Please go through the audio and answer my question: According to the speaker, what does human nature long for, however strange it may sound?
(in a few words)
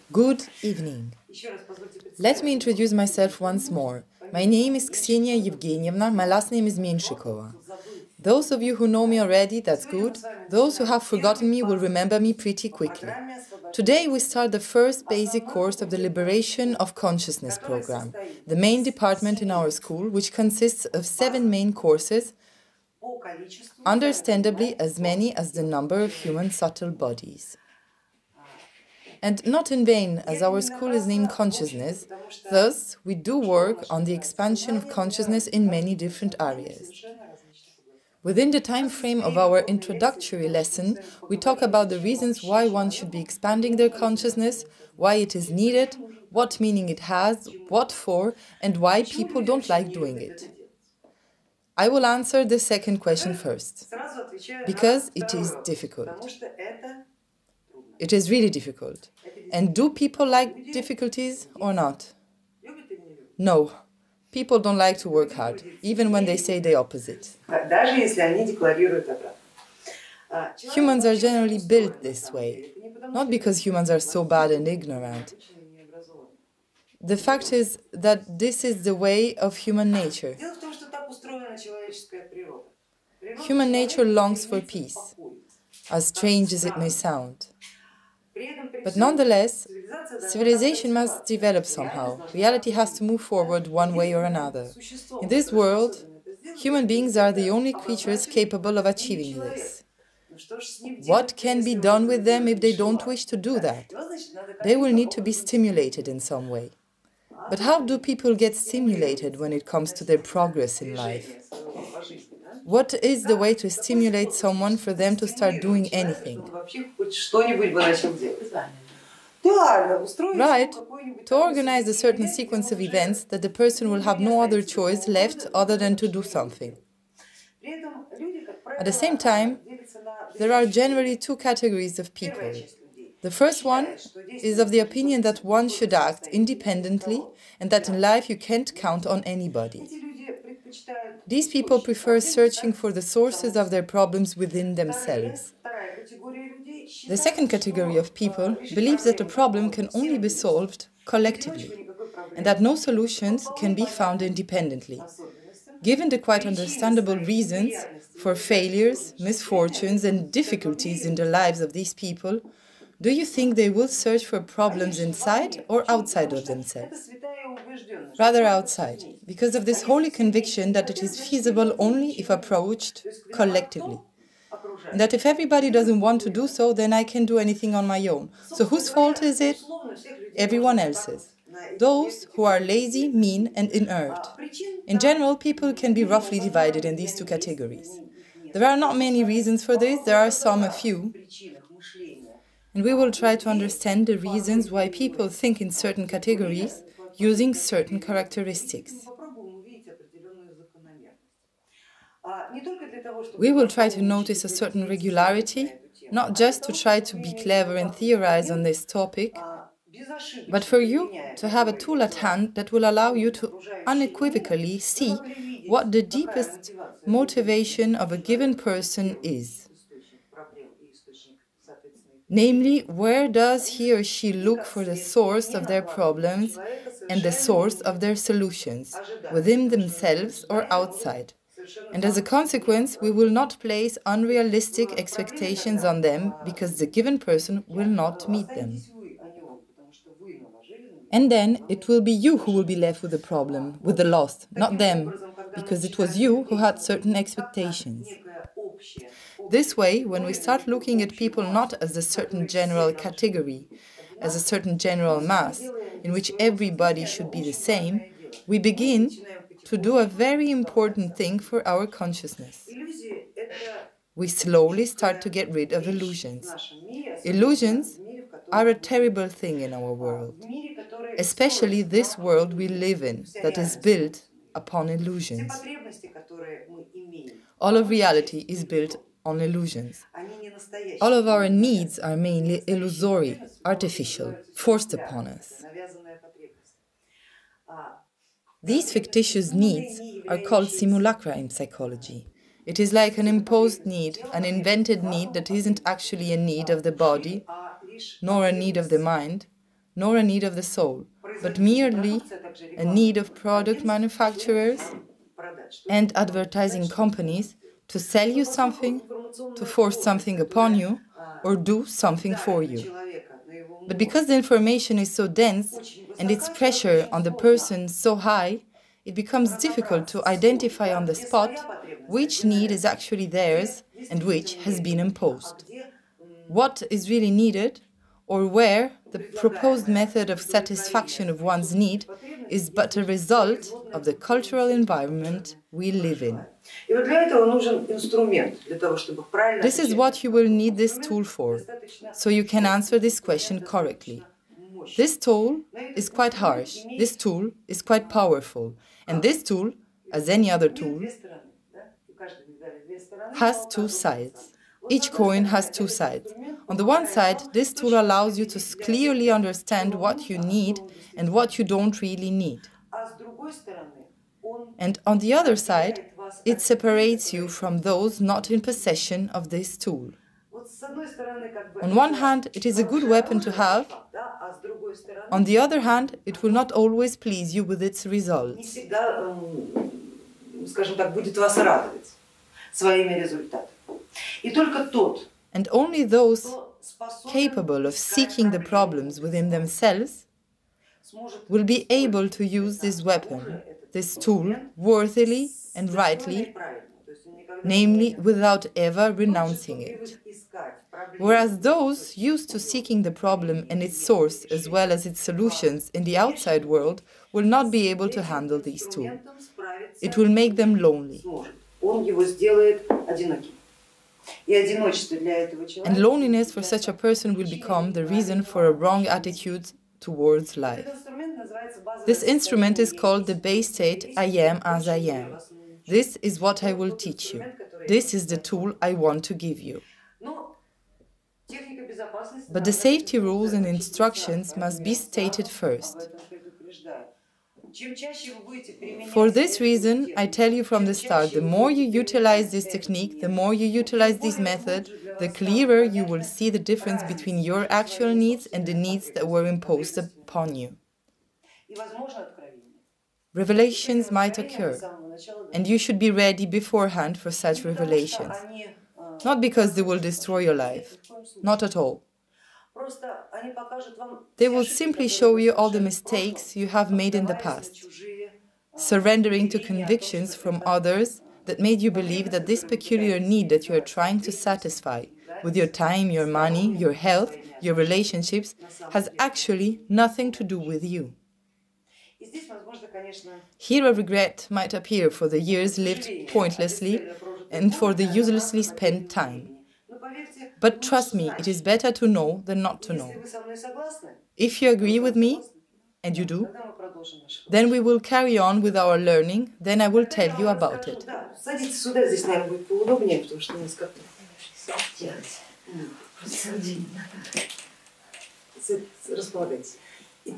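peace.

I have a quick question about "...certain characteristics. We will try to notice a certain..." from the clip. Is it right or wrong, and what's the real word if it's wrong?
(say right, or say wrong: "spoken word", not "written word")
right.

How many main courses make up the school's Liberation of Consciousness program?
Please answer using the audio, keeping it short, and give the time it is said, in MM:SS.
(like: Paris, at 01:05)
7, at 00:21.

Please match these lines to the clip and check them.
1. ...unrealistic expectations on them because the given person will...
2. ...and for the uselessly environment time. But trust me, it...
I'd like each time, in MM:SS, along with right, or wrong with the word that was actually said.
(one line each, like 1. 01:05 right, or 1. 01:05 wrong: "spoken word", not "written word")
1. 03:54 right
2. 08:07 wrong: "spent", not "environment".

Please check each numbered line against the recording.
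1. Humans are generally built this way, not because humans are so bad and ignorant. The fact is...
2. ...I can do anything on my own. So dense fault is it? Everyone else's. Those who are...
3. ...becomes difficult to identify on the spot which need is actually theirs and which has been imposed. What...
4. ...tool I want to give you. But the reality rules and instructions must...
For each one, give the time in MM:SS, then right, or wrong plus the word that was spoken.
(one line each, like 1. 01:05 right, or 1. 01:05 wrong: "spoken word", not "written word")
1. 01:10 right
2. 02:56 wrong: "whose", not "dense"
3. 05:19 right
4. 07:08 wrong: "safety", not "reality".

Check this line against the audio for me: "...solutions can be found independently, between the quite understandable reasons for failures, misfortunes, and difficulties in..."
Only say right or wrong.
wrong.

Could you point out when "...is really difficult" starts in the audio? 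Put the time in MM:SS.
00:58.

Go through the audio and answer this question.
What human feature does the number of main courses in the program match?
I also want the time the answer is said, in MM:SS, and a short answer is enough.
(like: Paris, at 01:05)
subtle bodies, at 00:26.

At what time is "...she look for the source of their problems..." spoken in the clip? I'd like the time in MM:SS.
03:44.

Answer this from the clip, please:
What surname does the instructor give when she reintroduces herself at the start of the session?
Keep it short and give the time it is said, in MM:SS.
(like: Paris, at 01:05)
Menshikova, at 00:06.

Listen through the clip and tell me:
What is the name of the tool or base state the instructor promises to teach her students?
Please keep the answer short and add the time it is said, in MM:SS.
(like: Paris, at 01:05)
I am as I am, at 07:04.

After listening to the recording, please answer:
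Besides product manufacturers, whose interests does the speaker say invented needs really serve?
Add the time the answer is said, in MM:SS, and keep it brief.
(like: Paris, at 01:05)
advertising companies, at 05:06.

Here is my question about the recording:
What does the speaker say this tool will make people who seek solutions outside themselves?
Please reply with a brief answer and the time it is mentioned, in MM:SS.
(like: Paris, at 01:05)
lonely, at 06:50.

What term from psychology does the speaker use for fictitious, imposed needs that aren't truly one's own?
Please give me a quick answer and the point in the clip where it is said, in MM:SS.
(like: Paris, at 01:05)
simulacra, at 04:50.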